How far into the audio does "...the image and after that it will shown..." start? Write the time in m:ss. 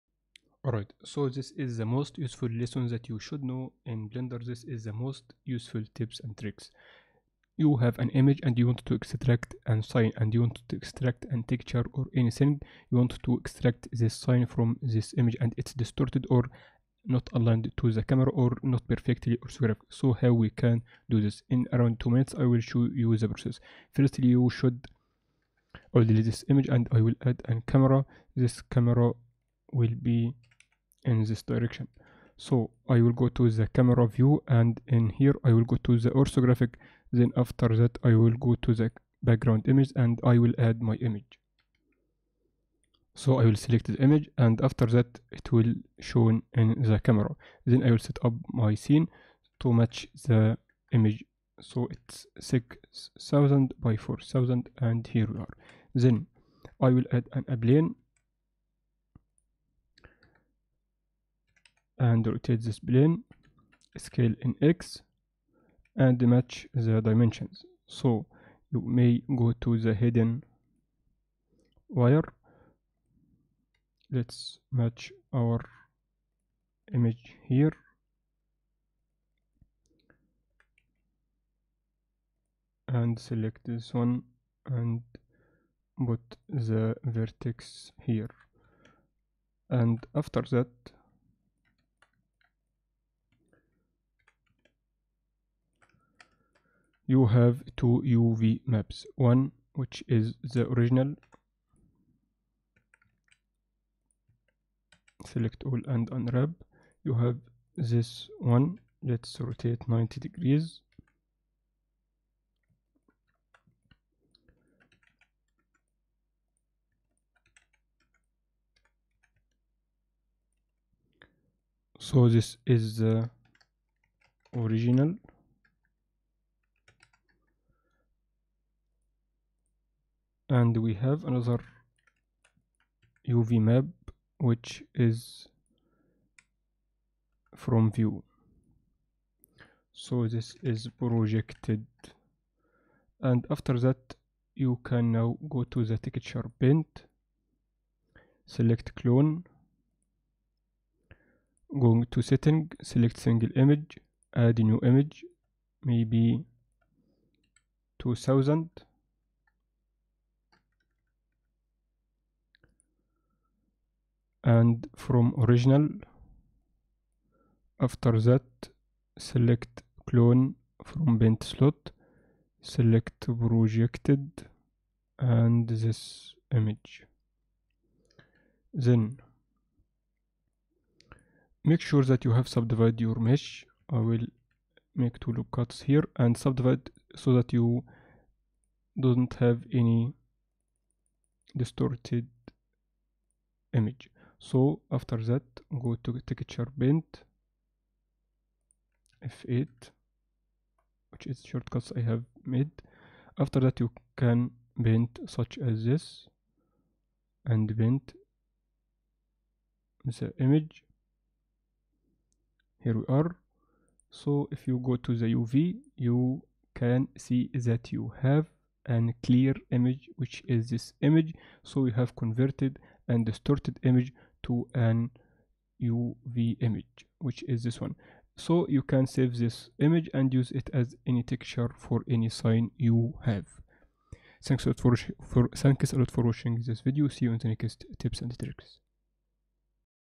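0:43.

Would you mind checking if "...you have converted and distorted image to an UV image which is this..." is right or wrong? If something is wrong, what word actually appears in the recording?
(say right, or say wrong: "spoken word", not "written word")
right.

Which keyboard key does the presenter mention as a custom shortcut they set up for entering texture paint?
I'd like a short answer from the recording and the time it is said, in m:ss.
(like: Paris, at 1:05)
F8, at 3:19.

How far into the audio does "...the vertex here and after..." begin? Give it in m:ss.
1:26.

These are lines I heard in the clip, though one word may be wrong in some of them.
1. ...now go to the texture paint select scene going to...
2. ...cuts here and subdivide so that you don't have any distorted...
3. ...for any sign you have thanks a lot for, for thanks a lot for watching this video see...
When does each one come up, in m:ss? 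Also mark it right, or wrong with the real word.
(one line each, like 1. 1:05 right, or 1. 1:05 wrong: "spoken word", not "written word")
1. 2:25 wrong: "clone", not "scene"
2. 3:05 right
3. 3:51 right.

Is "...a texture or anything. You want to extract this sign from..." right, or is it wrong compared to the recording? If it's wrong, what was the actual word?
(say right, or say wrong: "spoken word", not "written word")
right.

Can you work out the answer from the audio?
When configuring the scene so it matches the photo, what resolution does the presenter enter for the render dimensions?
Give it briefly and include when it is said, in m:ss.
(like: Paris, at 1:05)
6000 by 4000, at 0:52.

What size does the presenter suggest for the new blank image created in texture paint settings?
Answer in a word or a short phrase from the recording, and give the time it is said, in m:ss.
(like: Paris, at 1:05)
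2000, at 2:37.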